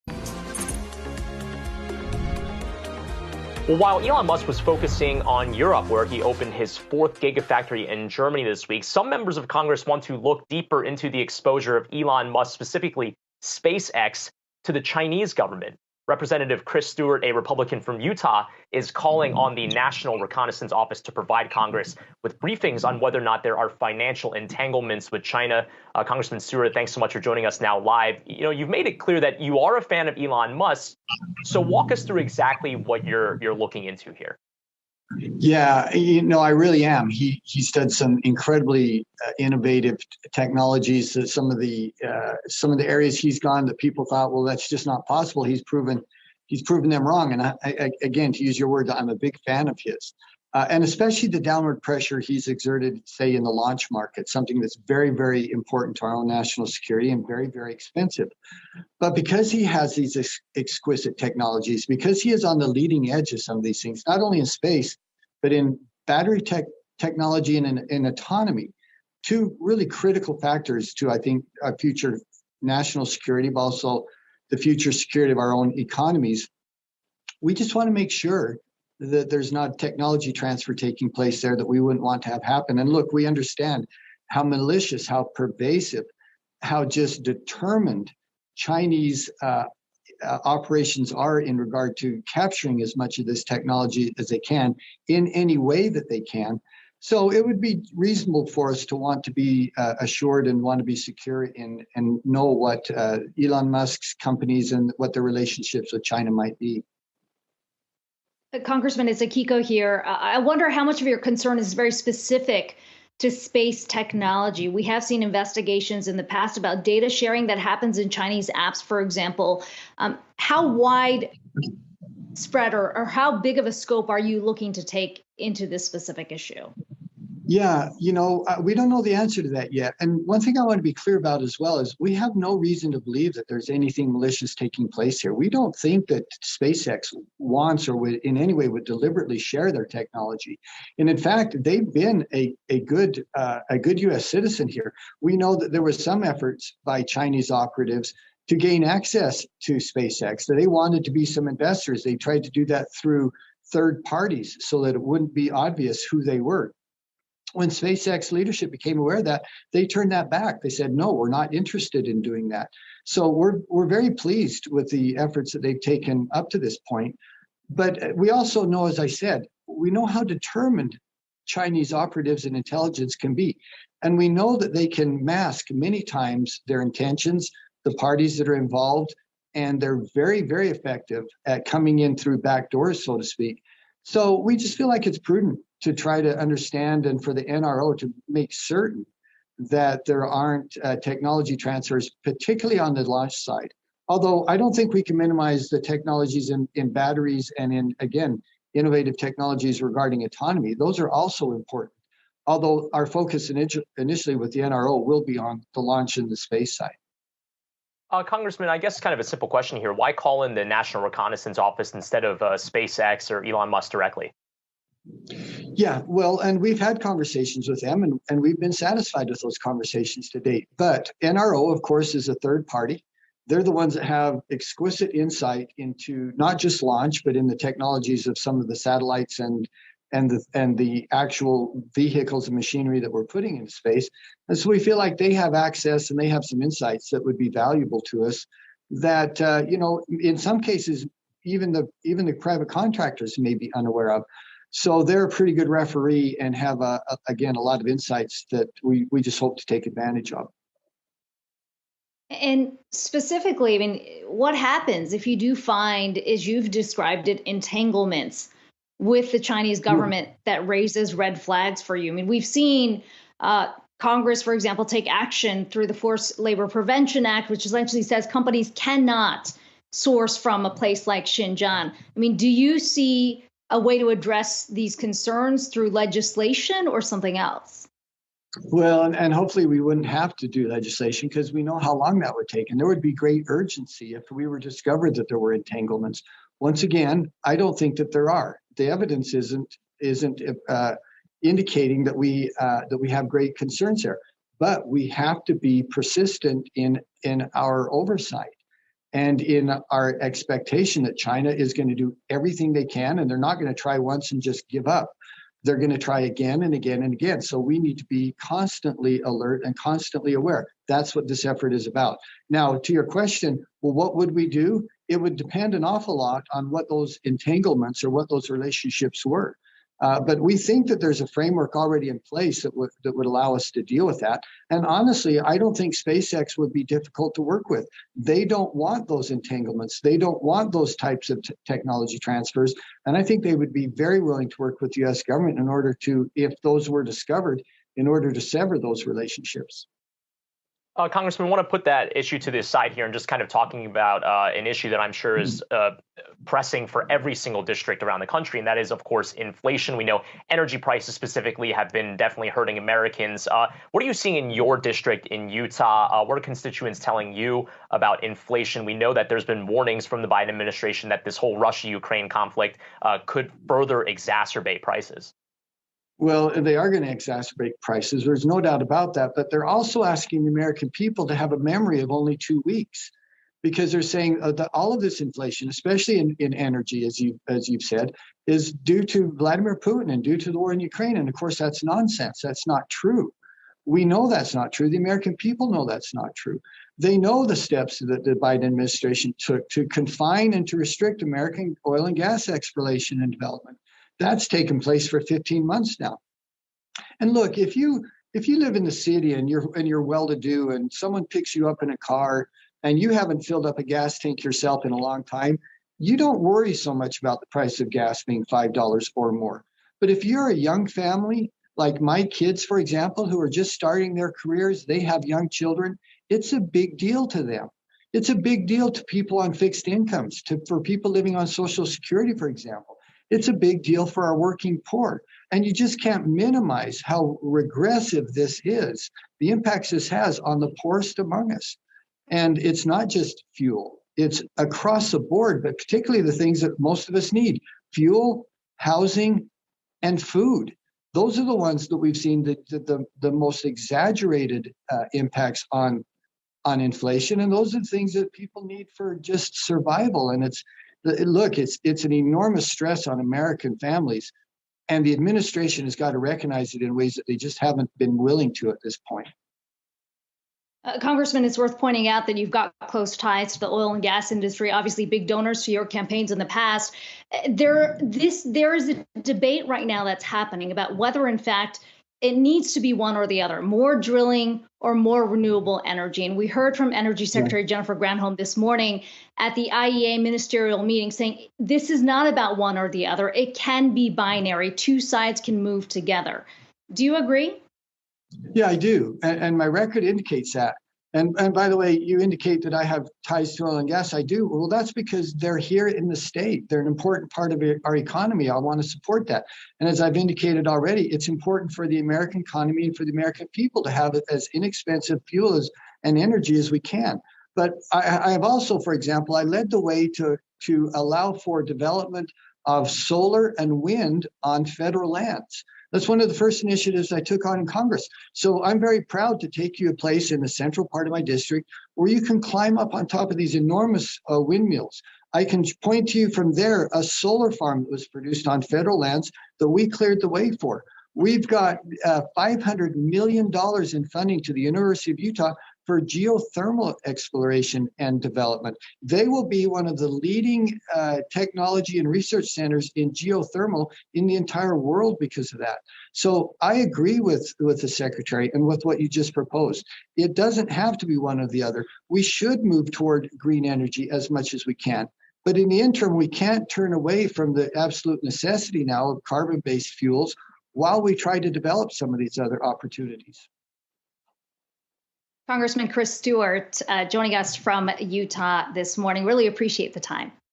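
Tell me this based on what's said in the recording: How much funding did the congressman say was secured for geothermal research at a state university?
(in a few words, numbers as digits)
$500 million.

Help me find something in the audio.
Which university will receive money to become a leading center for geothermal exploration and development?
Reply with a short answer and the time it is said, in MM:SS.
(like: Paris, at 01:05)
University of Utah, at 08:54.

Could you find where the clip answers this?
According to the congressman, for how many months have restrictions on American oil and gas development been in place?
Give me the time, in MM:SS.
06:35.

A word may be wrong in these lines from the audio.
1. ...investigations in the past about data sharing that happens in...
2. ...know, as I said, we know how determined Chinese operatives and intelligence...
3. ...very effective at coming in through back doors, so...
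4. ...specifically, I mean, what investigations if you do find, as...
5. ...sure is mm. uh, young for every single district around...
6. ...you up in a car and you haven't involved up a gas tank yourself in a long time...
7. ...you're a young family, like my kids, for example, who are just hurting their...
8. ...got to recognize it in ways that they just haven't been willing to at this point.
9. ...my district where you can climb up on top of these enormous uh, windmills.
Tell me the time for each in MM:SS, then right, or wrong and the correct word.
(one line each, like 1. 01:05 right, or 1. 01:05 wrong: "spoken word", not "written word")
1. 01:55 right
2. 02:48 right
3. 03:00 right
4. 04:12 wrong: "happens", not "investigations"
5. 05:45 wrong: "pressing", not "young"
6. 06:41 wrong: "filled", not "involved"
7. 06:50 wrong: "starting", not "hurting"
8. 07:35 right
9. 08:41 right.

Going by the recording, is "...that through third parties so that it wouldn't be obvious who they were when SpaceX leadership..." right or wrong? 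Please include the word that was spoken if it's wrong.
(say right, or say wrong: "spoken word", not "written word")
right.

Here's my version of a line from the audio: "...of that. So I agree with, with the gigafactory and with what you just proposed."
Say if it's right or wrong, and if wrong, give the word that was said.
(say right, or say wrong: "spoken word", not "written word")
wrong: "secretary", not "gigafactory".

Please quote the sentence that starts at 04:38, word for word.
Well, and, and hopefully we wouldn't have to do legislation because we know how long that would take.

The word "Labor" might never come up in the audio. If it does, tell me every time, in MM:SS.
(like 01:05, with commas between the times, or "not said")
04:26.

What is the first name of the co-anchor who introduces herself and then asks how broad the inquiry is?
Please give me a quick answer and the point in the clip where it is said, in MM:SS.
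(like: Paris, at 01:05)
Akiko, at 01:49.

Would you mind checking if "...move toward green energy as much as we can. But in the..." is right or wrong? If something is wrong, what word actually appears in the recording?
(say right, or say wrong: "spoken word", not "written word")
right.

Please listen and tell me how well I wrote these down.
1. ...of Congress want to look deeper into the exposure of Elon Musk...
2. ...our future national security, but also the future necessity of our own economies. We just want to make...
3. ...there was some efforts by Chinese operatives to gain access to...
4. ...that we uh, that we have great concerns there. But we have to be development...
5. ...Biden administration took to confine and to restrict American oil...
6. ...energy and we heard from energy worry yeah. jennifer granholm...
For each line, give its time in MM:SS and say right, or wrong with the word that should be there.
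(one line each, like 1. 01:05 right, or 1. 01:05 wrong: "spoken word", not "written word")
1. 00:09 right
2. 01:11 wrong: "security", not "necessity"
3. 02:25 right
4. 04:52 wrong: "persistent", not "development"
5. 06:28 right
6. 07:55 wrong: "secretary", not "worry".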